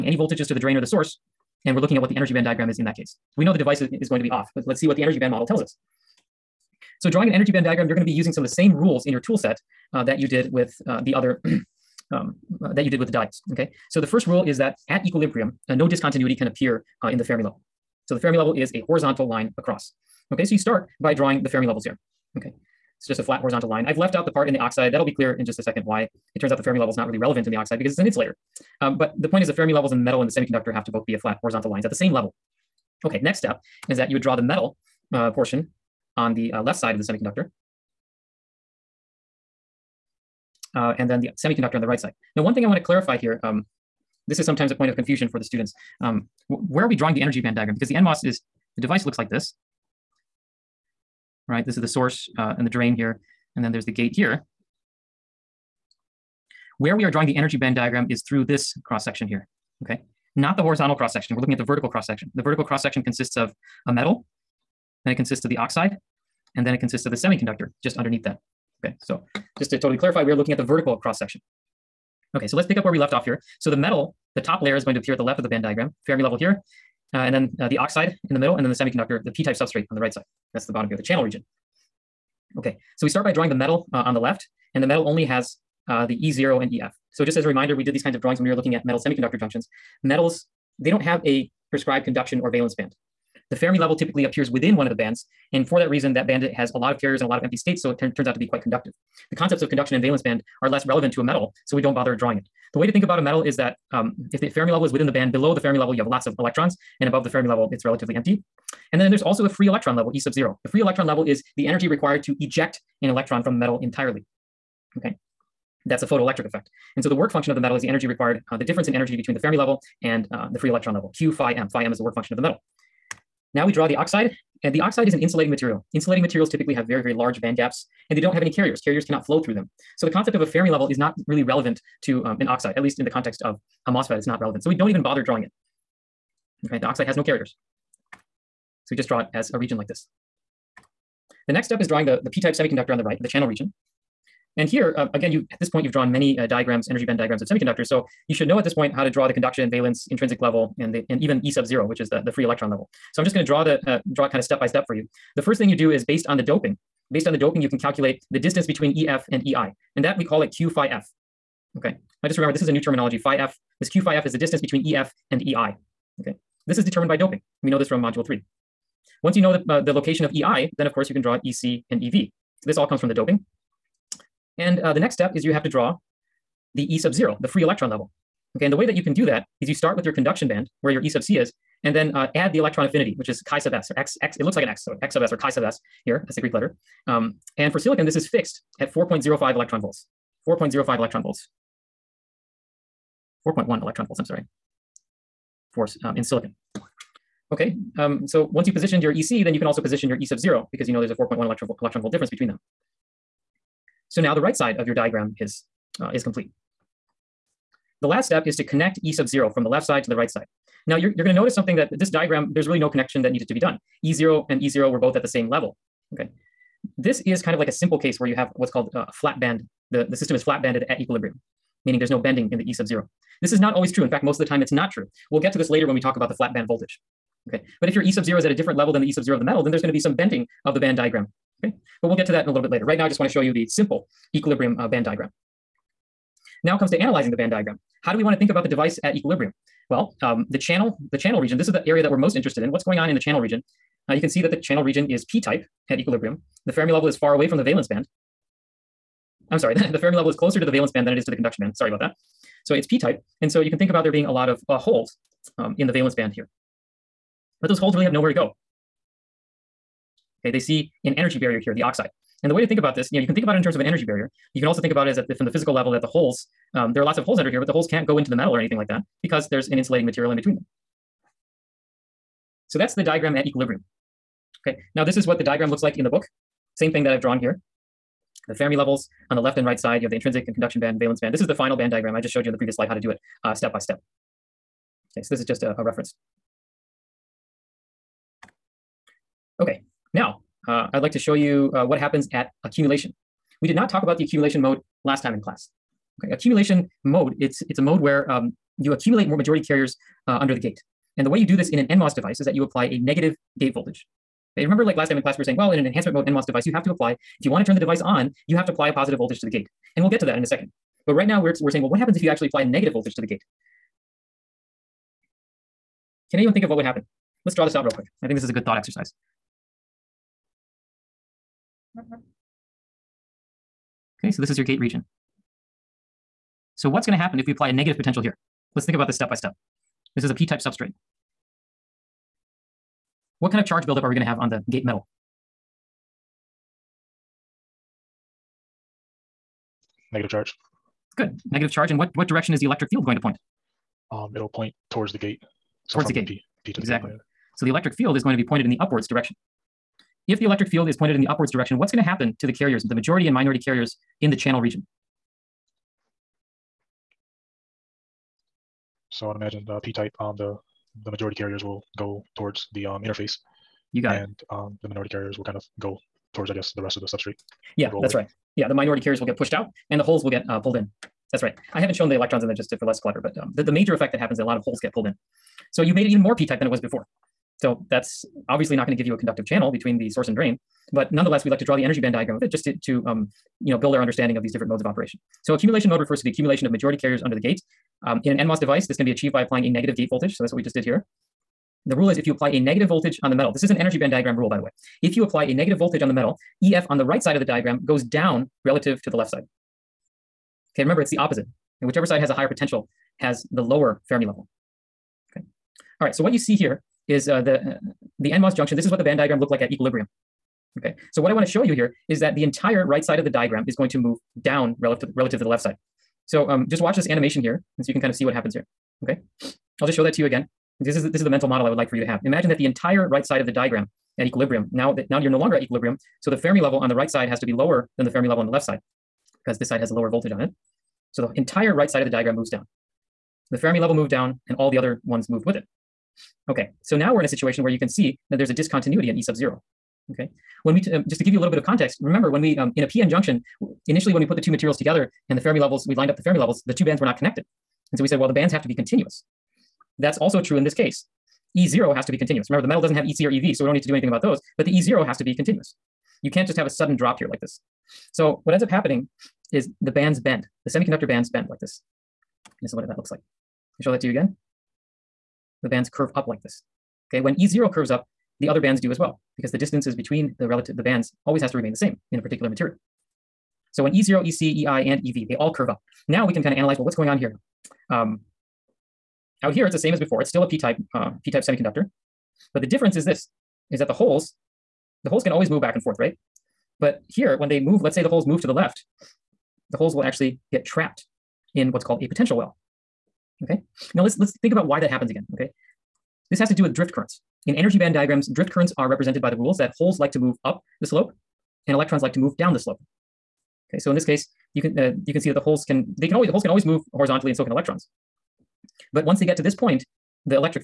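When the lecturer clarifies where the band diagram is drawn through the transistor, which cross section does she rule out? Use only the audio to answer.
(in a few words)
The horizontal cross section.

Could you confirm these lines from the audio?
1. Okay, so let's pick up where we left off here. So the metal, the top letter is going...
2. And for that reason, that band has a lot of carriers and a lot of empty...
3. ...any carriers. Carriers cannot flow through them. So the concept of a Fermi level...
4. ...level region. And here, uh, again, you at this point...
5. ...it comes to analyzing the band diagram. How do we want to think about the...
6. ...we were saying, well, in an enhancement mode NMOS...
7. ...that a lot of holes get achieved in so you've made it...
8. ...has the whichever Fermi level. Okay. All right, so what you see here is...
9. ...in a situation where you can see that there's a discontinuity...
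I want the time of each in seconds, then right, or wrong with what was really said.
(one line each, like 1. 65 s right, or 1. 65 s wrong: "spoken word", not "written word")
1. 72 s wrong: "layer", not "letter"
2. 95 s right
3. 128 s right
4. 143 s wrong: "channel", not "level"
5. 236 s right
6. 305 s right
7. 374 s wrong: "pulled", not "achieved"
8. 403 s wrong: "lower", not "whichever"
9. 437 s right.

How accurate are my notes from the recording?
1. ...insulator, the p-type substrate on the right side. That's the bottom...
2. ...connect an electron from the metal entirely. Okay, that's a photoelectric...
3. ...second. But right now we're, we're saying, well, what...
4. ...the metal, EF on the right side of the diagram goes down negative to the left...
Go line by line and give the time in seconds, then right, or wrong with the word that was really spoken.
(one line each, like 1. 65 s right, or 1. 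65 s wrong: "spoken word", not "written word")
1. 78 s wrong: "semiconductor", not "insulator"
2. 112 s wrong: "eject", not "connect"
3. 310 s right
4. 396 s wrong: "relative", not "negative".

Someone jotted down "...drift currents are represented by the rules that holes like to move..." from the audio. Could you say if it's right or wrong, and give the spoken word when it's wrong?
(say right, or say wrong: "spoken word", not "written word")
right.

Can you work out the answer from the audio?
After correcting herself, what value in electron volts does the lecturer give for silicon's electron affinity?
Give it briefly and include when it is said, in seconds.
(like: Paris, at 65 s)
4.1 electron volts, at 193 s.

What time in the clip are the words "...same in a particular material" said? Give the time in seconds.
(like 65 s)
471 s.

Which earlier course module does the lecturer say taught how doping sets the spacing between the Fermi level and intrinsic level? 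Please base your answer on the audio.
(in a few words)
Module three.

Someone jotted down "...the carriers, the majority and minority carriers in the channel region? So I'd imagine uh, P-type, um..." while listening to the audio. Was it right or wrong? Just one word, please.
right.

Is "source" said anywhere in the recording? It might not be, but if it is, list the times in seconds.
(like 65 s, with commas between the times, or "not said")
0 s, 51 s, 380 s.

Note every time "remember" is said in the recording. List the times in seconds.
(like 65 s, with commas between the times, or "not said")
162 s, 304 s, 400 s, 442 s, 452 s.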